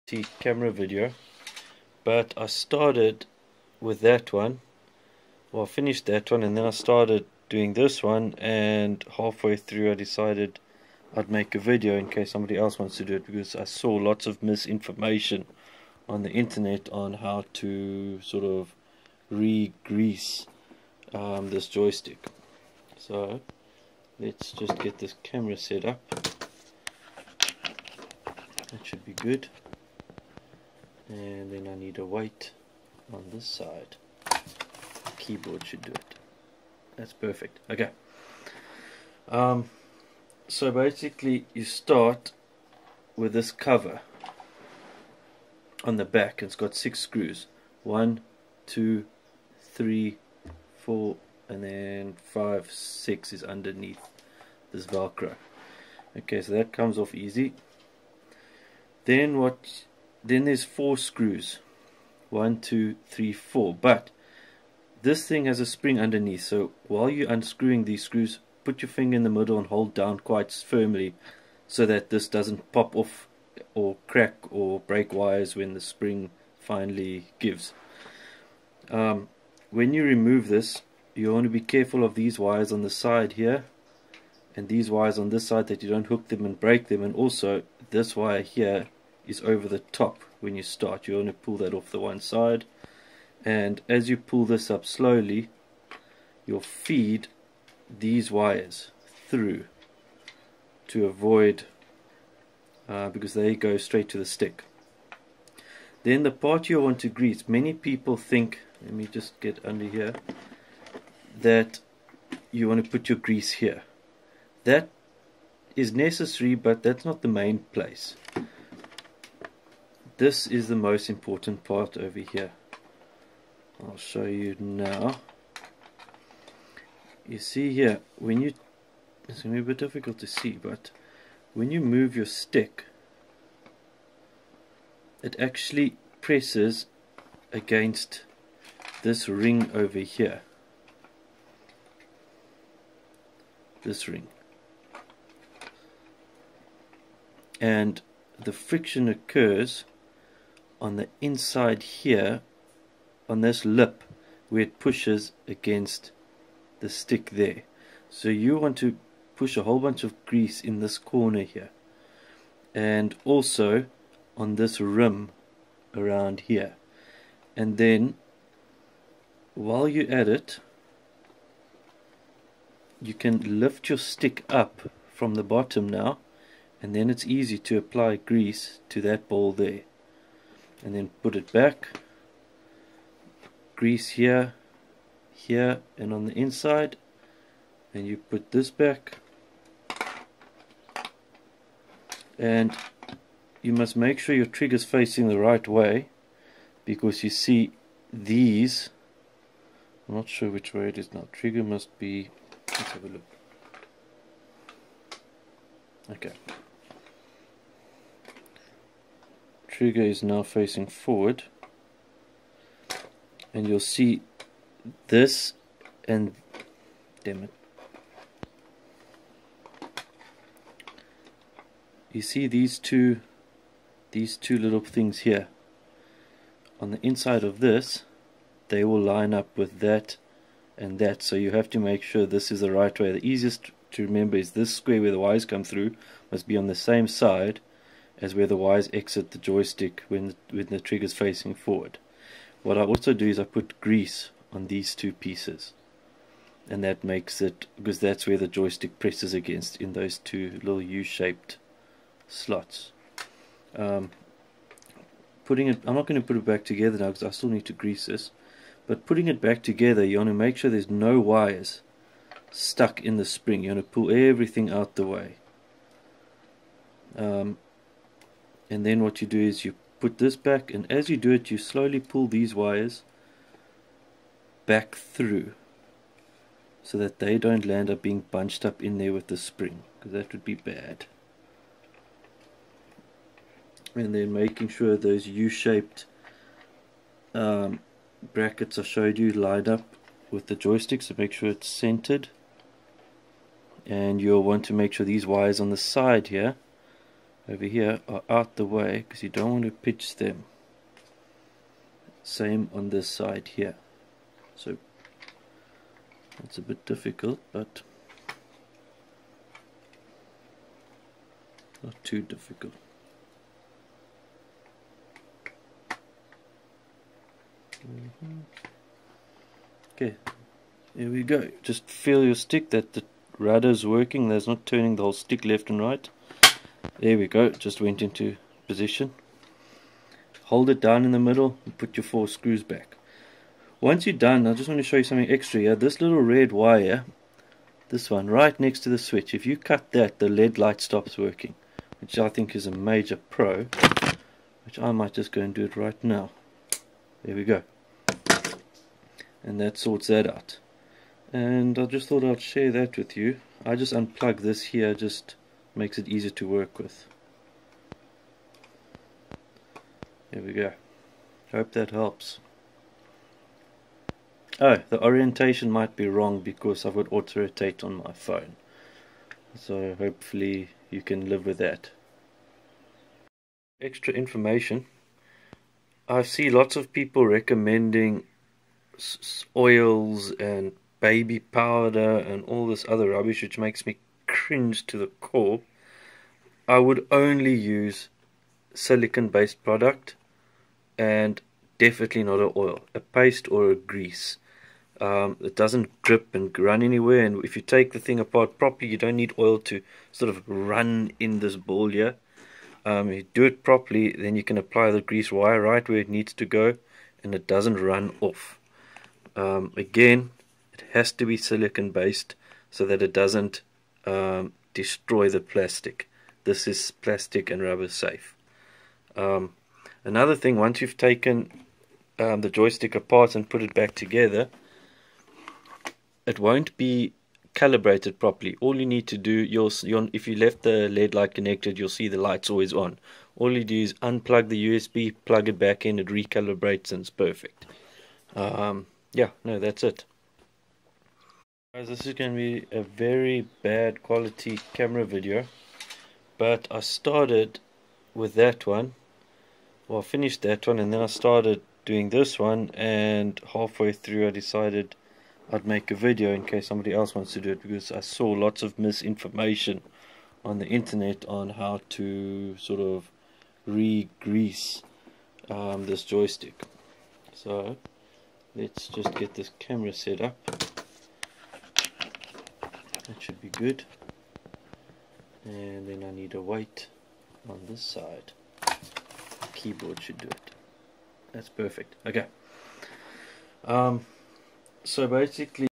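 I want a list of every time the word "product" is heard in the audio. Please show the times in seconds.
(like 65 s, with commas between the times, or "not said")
389 s.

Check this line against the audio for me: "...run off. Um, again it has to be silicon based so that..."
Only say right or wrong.
right.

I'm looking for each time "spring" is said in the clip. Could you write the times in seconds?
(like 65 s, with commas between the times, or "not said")
65 s, 75 s, 263 s, 279 s.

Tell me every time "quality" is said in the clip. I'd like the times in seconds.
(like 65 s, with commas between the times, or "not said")
444 s.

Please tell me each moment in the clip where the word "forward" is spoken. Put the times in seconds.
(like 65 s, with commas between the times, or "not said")
210 s, 241 s.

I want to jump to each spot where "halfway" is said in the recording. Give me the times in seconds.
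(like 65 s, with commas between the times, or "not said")
9 s, 453 s.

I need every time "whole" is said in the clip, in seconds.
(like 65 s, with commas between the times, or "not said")
159 s, 325 s.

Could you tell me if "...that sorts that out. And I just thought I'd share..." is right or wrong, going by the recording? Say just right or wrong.
right.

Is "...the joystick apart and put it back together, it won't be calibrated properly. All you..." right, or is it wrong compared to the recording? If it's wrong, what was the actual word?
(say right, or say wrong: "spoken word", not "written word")
right.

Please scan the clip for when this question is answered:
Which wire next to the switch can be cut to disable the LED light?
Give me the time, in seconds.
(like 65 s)
336 s.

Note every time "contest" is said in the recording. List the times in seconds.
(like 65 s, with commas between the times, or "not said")
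not said.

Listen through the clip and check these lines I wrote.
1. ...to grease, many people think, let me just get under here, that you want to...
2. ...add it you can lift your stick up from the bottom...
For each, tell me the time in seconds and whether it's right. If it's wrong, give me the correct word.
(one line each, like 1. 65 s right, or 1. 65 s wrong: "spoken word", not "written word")
1. 106 s right
2. 170 s right.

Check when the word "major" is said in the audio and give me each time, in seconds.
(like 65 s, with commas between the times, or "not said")
342 s.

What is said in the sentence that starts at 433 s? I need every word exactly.
All you do is unplug the USB, plug it back in, it recalibrates and it's perfect.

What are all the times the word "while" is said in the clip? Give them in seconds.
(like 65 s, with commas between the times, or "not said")
66 s, 169 s.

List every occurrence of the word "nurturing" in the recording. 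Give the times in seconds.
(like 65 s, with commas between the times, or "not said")
not said.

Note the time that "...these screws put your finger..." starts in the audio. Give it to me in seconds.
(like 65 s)
67 s.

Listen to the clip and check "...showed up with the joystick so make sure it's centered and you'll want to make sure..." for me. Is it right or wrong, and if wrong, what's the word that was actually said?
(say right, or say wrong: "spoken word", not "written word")
wrong: "lined", not "showed".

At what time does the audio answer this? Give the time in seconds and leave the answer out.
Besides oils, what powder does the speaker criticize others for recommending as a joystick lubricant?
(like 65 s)
380 s.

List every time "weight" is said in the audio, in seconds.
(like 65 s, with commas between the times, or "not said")
476 s.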